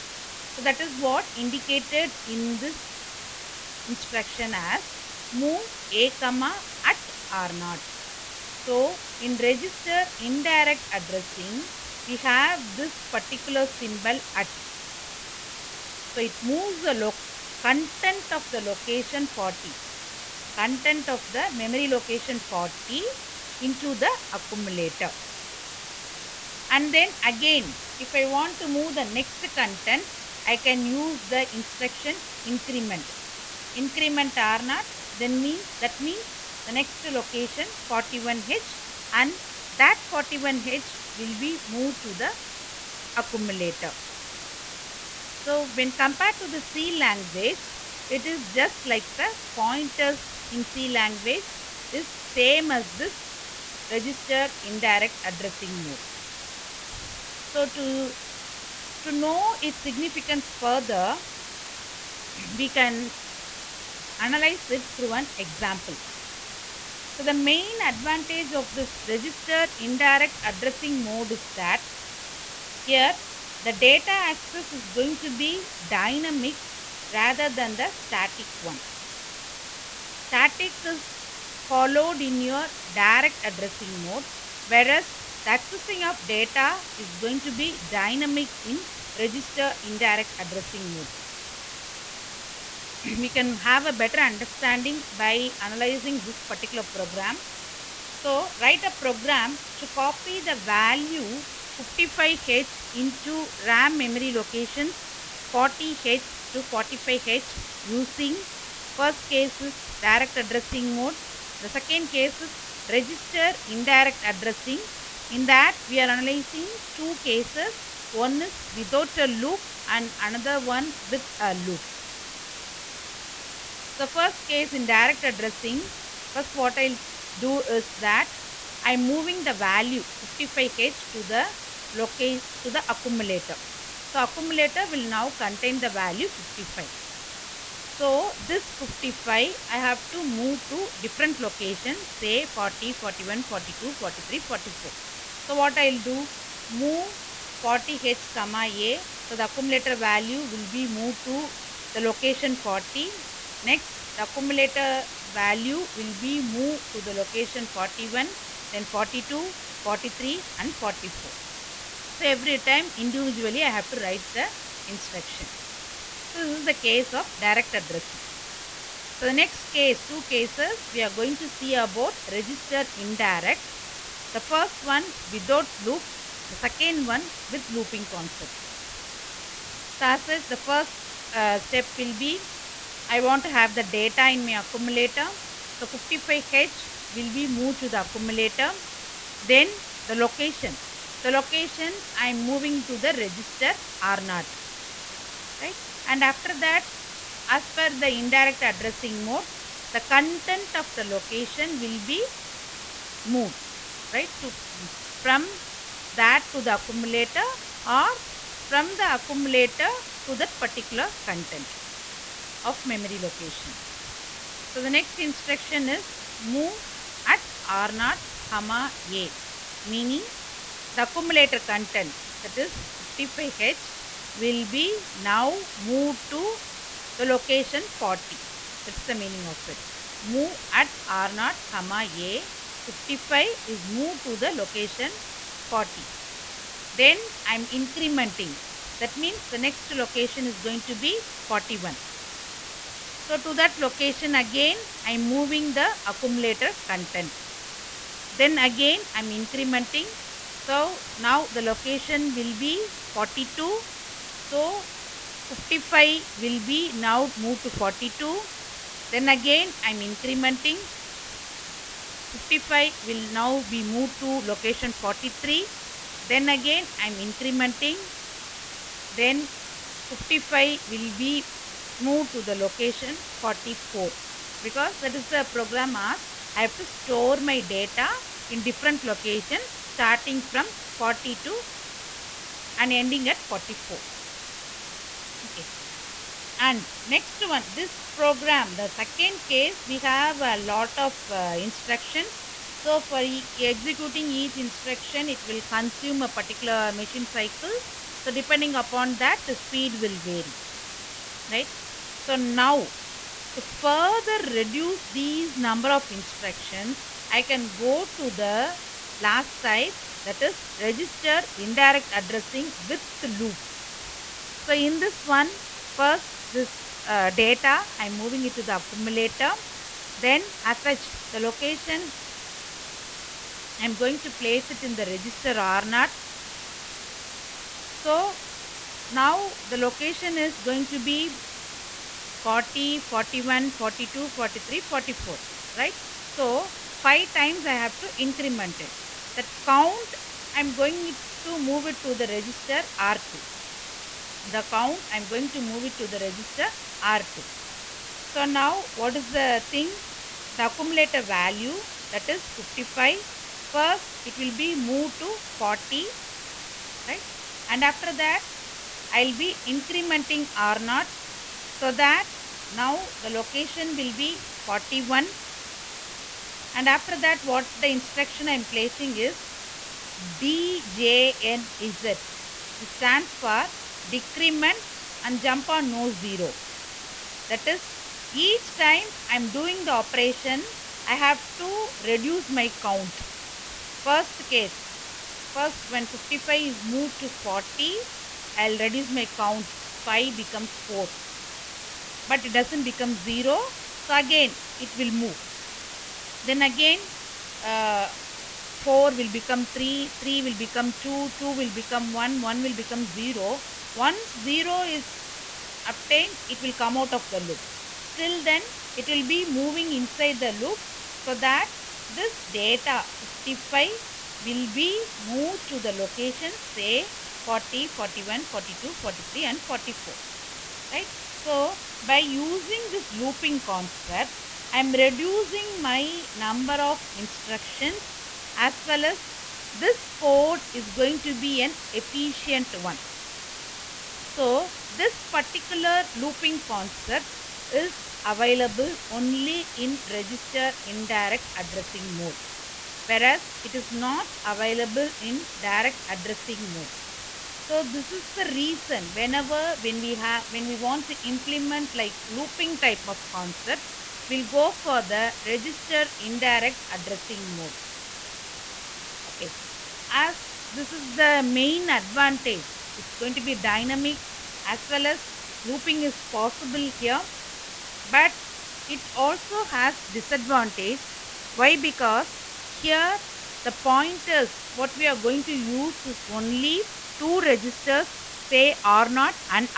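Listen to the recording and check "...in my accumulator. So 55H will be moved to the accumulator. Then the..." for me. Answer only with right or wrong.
right.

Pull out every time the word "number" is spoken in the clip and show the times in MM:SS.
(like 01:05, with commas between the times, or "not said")
05:05, 07:06.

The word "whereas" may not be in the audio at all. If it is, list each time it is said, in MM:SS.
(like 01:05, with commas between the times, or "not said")
01:24, 07:23.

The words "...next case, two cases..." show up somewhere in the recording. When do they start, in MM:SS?
02:49.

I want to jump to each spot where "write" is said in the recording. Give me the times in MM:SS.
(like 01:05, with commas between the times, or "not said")
01:38, 02:43.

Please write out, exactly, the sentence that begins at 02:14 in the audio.
So accumulator will now contain the value 55.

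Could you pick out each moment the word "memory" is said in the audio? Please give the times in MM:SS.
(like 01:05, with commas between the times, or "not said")
00:21, 01:43, 03:32.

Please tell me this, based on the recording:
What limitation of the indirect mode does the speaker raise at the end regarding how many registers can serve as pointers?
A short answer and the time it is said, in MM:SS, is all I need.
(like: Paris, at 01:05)
Only two registers, at 07:56.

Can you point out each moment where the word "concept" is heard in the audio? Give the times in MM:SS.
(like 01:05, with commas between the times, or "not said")
02:58, 07:03, 07:16, 07:33.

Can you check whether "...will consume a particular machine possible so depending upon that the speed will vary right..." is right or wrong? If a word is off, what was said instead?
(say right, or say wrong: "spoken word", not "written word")
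wrong: "cycle", not "possible".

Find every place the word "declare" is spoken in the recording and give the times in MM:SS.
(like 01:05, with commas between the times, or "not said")
not said.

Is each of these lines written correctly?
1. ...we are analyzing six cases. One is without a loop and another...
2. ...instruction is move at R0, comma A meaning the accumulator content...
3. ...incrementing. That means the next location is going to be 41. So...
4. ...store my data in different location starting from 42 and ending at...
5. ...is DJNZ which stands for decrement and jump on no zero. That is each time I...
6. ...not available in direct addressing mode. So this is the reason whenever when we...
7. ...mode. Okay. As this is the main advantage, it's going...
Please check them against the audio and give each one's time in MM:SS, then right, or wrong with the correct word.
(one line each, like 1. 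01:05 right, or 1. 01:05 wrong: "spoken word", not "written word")
1. 01:55 wrong: "two", not "six"
2. 03:35 right
3. 03:57 right
4. 04:36 right
5. 06:09 right
6. 07:23 right
7. 07:37 right.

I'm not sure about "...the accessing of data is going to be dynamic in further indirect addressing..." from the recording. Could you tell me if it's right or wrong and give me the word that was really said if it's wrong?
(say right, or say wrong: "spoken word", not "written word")
wrong: "register", not "further".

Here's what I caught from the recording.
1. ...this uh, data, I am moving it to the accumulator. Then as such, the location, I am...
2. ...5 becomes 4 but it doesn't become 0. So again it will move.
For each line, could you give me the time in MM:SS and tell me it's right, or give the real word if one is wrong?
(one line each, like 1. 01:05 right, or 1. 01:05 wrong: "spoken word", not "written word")
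1. 05:16 right
2. 06:30 right.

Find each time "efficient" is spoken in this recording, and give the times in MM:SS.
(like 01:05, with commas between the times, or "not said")
07:11.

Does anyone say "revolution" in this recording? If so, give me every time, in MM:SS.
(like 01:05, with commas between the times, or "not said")
not said.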